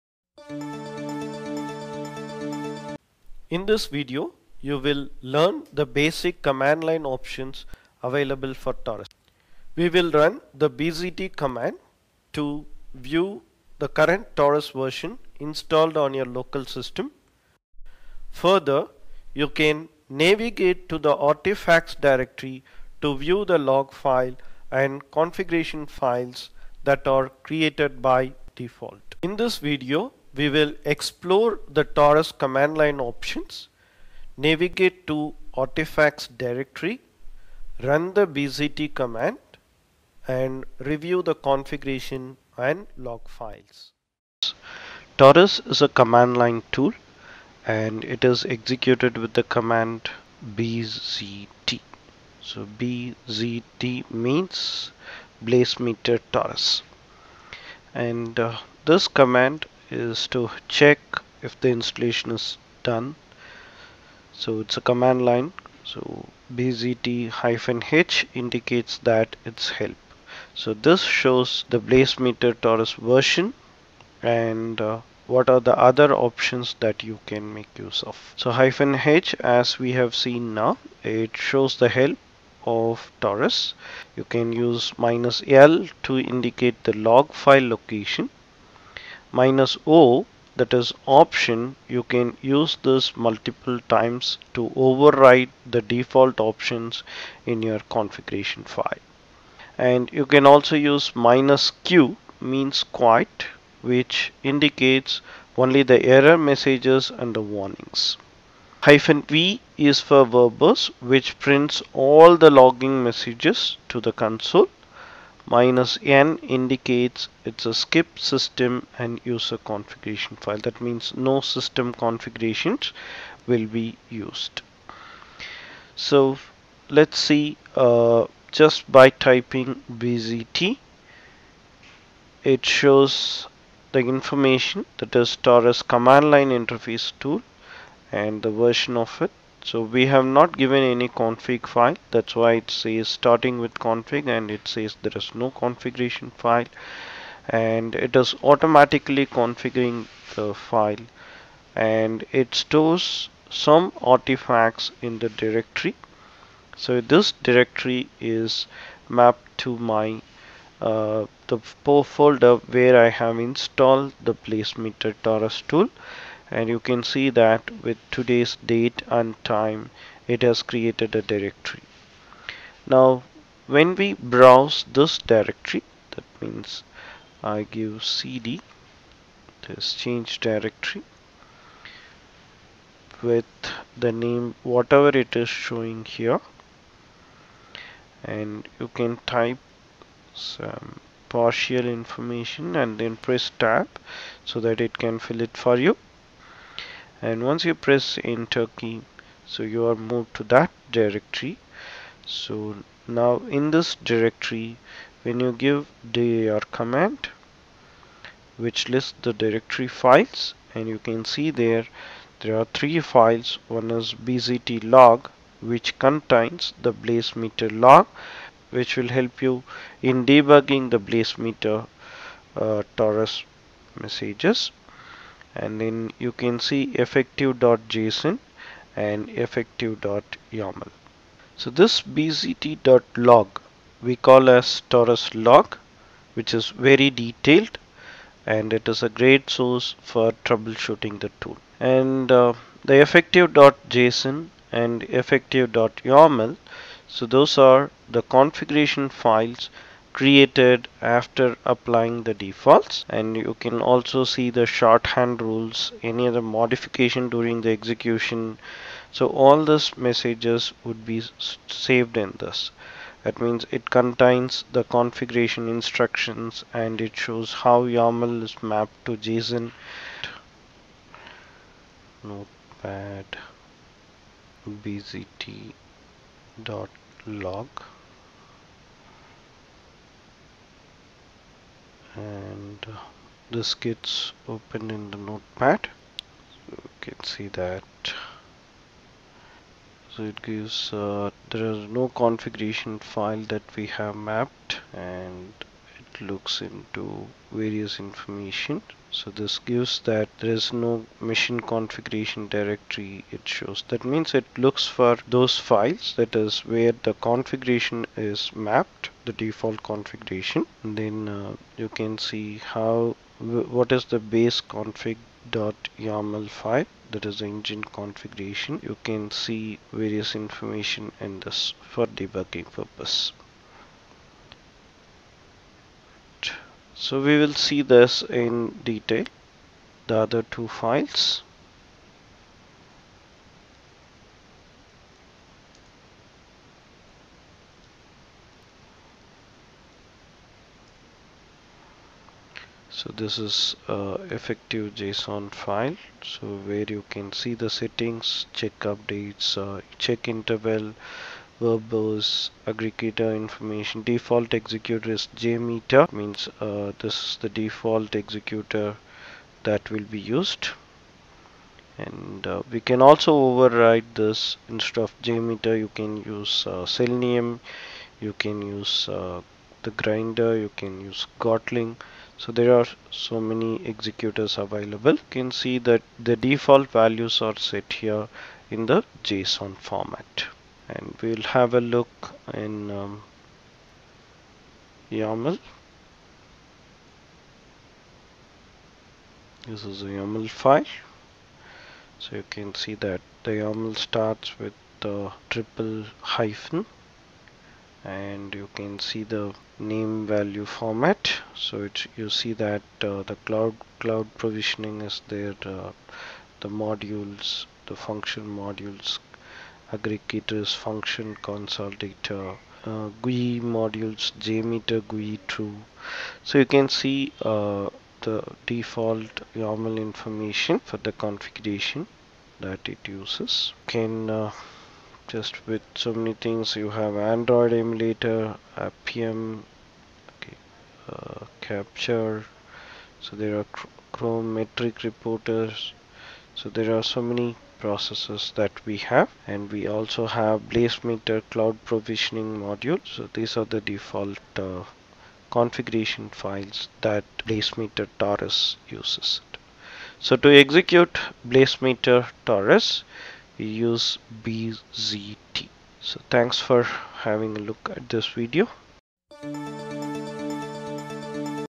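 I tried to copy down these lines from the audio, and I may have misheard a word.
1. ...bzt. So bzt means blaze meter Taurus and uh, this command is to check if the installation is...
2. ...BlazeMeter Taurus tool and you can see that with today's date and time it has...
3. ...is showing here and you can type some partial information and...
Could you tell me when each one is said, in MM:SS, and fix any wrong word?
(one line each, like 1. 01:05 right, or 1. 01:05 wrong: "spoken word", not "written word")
1. 00:50 right
2. 02:44 right
3. 03:05 right.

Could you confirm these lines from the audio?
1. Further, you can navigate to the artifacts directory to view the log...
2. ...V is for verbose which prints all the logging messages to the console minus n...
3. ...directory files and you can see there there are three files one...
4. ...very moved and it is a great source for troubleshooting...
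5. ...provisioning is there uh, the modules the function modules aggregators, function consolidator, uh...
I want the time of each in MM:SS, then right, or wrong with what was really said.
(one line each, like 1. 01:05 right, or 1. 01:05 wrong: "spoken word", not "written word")
1. 00:18 right
2. 01:49 right
3. 03:29 right
4. 03:56 wrong: "detailed", not "moved"
5. 06:44 right.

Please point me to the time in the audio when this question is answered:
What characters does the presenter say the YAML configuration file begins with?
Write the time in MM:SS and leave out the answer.
06:35.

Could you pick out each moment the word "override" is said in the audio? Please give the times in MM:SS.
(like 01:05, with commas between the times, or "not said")
01:34, 06:03.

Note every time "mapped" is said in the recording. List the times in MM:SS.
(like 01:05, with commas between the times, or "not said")
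02:39, 04:28, 04:54, 05:08.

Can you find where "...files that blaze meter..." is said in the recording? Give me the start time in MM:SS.
07:26.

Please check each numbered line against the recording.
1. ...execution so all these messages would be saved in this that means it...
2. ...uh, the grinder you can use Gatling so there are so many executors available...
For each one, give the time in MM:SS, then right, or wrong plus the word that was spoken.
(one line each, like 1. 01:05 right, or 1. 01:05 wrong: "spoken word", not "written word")
1. 04:17 right
2. 06:09 right.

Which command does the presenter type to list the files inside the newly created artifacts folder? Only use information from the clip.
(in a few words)
dir.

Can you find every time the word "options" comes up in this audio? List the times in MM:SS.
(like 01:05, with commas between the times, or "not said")
00:07, 00:33, 01:16, 01:31, 01:36.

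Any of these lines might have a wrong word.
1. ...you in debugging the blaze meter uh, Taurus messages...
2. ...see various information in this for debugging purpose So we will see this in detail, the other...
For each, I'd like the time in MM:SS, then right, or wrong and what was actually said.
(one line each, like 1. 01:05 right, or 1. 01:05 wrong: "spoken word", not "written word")
1. 03:39 right
2. 05:19 right.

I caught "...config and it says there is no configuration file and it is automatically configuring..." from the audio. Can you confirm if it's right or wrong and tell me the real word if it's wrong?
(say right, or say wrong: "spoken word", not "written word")
right.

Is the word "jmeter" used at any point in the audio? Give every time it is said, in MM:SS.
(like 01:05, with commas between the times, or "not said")
05:55, 06:05, 06:54.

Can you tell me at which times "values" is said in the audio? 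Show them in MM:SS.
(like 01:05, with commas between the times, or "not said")
06:17, 06:40.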